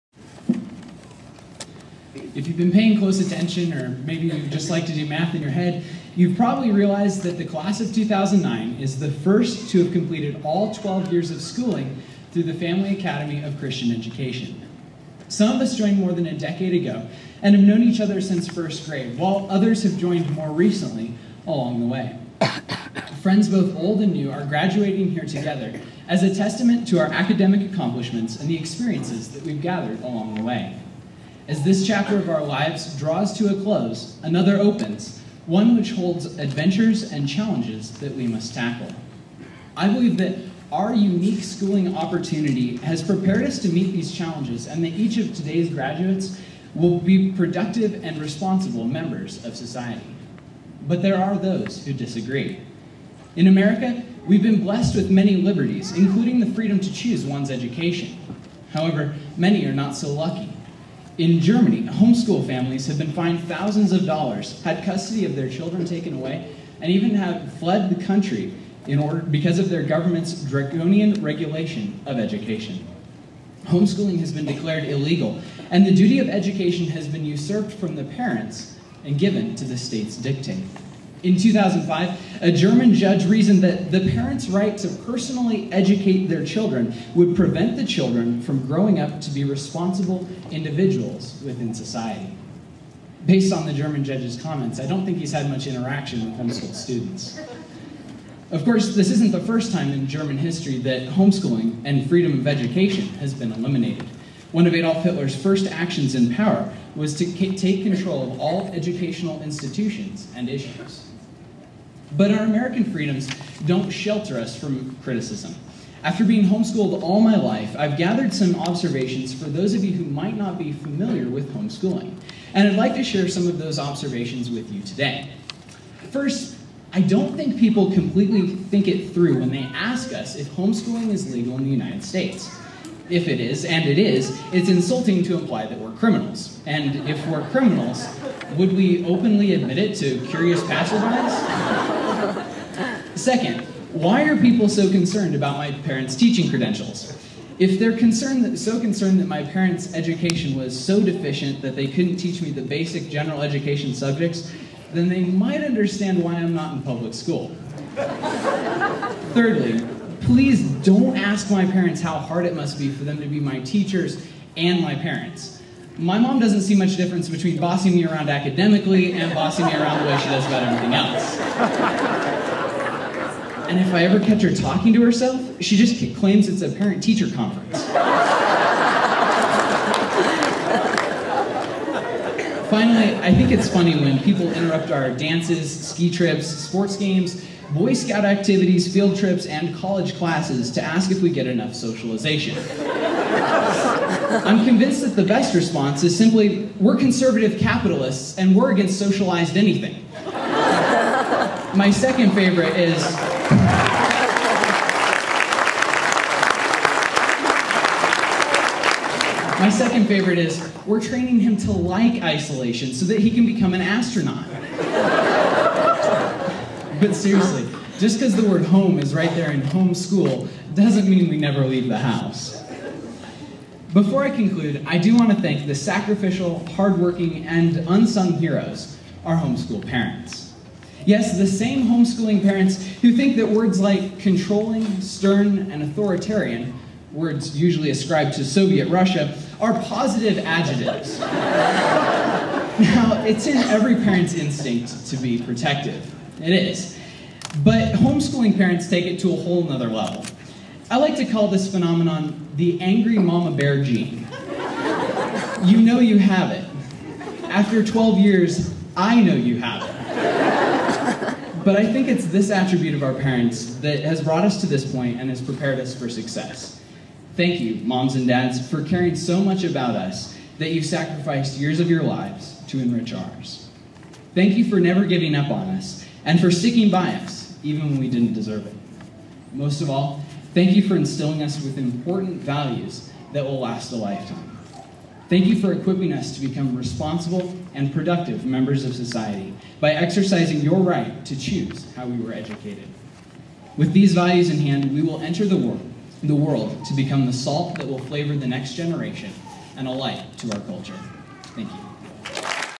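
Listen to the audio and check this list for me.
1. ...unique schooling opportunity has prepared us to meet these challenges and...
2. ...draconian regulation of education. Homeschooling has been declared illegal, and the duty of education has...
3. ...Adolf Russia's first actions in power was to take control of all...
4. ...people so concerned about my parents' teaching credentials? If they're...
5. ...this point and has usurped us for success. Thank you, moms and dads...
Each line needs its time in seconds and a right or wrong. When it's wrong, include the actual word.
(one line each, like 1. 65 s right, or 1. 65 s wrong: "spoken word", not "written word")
1. 40 s right
2. 70 s right
3. 104 s wrong: "Hitler", not "Russia"
4. 144 s right
5. 264 s wrong: "prepared", not "usurped".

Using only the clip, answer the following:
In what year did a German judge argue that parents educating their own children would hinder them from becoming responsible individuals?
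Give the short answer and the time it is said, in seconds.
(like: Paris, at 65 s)
2005, at 81 s.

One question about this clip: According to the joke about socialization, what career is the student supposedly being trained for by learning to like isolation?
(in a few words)
astronaut.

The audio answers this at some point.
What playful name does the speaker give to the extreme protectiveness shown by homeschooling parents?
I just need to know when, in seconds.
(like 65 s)
252 s.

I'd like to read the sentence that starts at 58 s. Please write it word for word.
However, many are not so lucky.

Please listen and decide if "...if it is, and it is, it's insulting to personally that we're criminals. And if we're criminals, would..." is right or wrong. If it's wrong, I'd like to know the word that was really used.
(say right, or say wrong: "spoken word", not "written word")
wrong: "imply", not "personally".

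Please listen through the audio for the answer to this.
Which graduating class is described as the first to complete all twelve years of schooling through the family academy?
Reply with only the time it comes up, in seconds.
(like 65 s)
7 s.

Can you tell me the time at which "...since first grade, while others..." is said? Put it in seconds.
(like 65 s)
18 s.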